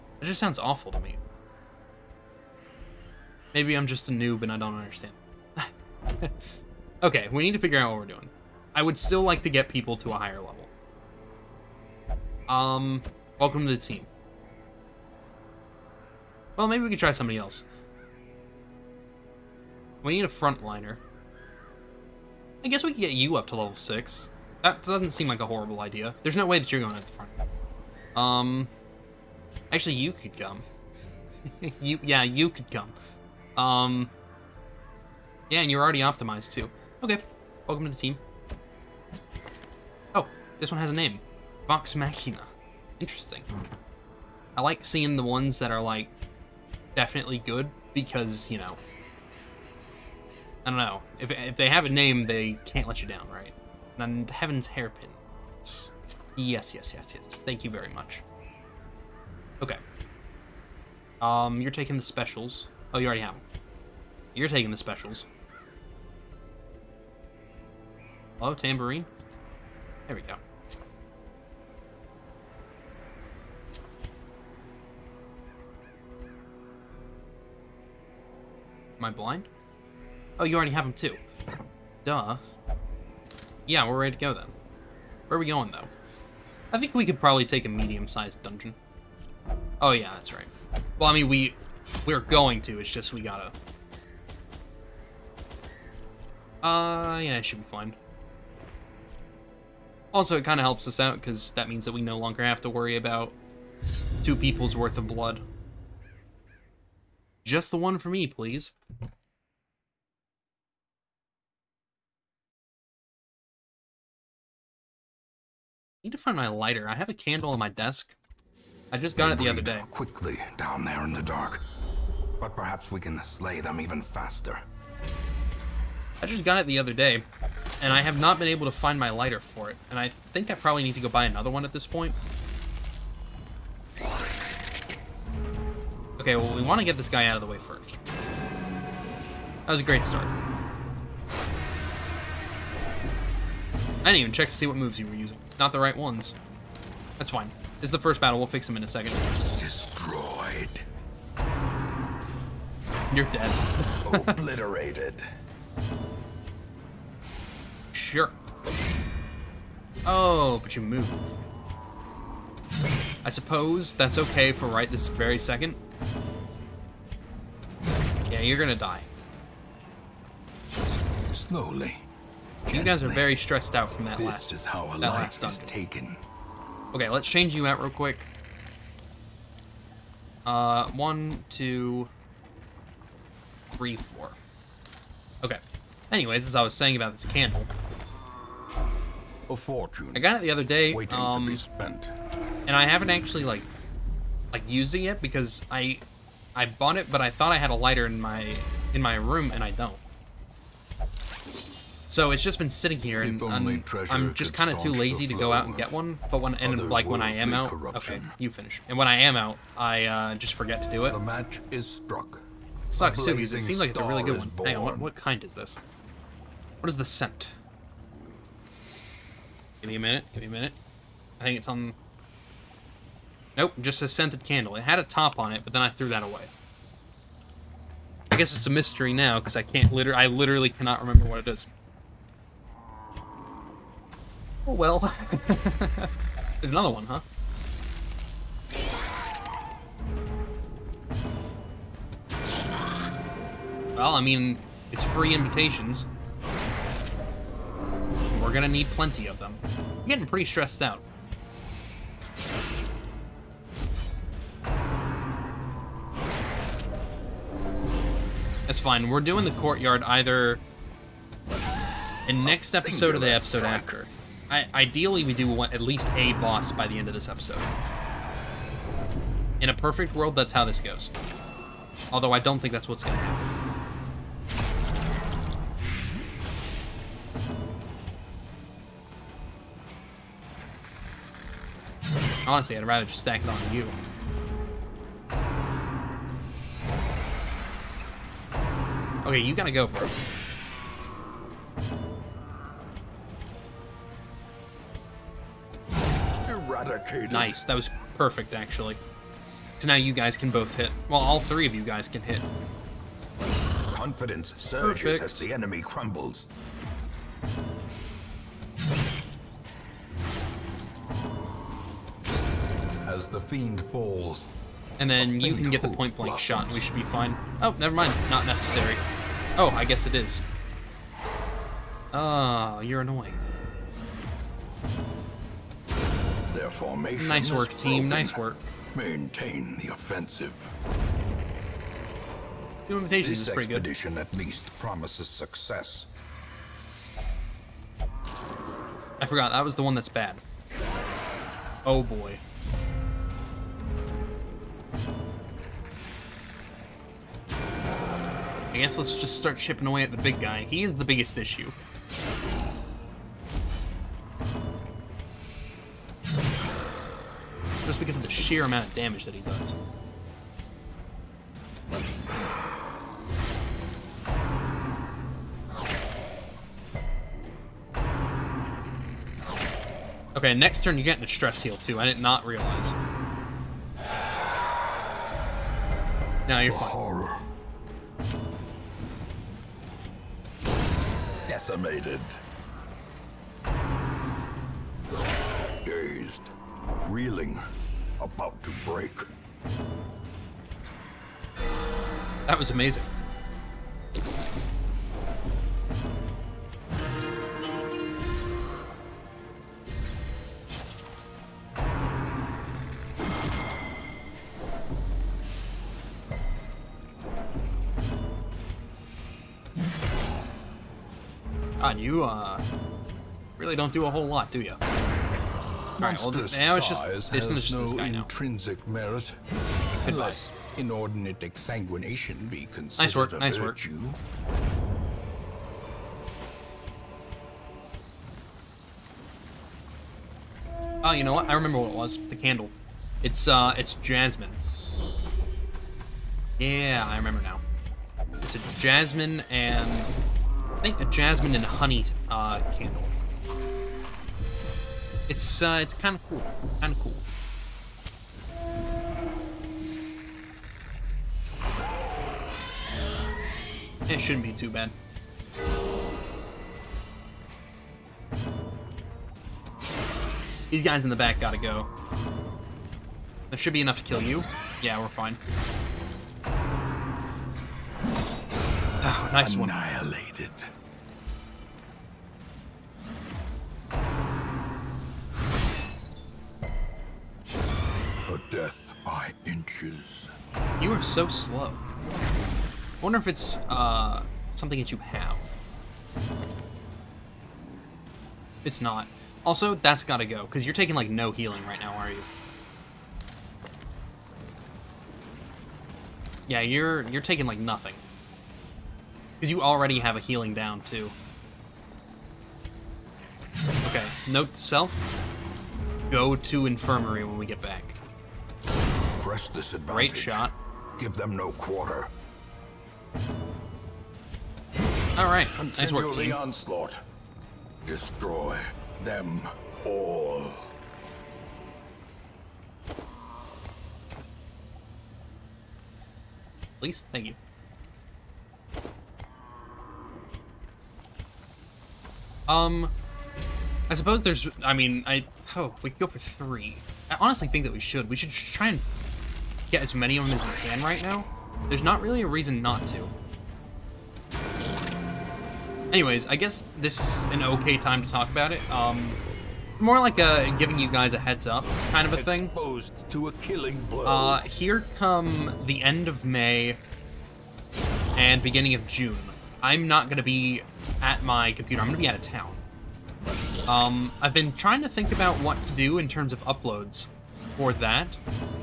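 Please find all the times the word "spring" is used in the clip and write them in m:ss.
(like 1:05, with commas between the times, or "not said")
not said.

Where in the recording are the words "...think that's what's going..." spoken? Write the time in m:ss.
4:32.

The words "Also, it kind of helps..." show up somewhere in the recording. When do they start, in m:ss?
1:40.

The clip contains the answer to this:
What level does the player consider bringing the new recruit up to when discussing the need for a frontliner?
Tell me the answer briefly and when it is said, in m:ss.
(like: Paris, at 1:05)
6, at 0:23.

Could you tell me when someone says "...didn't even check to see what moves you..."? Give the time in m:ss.
2:24.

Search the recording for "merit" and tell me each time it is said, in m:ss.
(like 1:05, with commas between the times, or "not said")
6:58.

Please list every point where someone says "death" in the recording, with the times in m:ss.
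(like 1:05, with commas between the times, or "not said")
7:58.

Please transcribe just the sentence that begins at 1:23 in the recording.
Yeah, we're ready to go then.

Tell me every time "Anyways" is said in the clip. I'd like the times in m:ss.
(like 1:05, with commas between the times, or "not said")
3:06, 9:05.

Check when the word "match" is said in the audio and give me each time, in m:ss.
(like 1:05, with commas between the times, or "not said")
3:31.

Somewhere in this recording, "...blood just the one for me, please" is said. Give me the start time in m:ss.
1:45.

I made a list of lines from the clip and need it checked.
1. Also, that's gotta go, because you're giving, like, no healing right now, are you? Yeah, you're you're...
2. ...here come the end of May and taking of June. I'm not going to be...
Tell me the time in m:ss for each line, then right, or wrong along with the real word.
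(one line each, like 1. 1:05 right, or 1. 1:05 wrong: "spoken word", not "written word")
1. 8:09 wrong: "taking", not "giving"
2. 9:14 wrong: "beginning", not "taking".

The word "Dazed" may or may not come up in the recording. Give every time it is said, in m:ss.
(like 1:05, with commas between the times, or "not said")
6:25.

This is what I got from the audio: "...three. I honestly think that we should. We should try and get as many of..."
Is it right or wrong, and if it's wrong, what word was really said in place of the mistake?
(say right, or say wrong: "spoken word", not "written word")
right.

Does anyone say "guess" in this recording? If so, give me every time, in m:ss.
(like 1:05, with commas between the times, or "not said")
0:22, 3:48, 5:19, 5:48, 9:06.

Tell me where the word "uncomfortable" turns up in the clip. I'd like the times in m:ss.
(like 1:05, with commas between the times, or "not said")
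not said.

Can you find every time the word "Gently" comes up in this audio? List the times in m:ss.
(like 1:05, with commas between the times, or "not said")
2:52.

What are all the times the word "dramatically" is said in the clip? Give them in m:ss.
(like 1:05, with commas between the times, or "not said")
not said.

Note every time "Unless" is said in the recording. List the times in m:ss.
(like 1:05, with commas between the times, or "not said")
7:00.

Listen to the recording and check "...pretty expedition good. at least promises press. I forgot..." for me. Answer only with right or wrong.
wrong.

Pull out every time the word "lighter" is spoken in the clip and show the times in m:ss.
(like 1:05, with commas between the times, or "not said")
1:56, 2:09, 3:17.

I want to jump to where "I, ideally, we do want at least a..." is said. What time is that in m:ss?
4:24.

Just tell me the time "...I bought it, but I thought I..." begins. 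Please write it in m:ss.
3:16.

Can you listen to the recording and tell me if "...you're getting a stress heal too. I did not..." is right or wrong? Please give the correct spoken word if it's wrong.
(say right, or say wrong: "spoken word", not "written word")
right.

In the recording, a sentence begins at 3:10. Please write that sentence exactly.
Waiting um, to be um, spent.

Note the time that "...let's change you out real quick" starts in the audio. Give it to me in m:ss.
2:57.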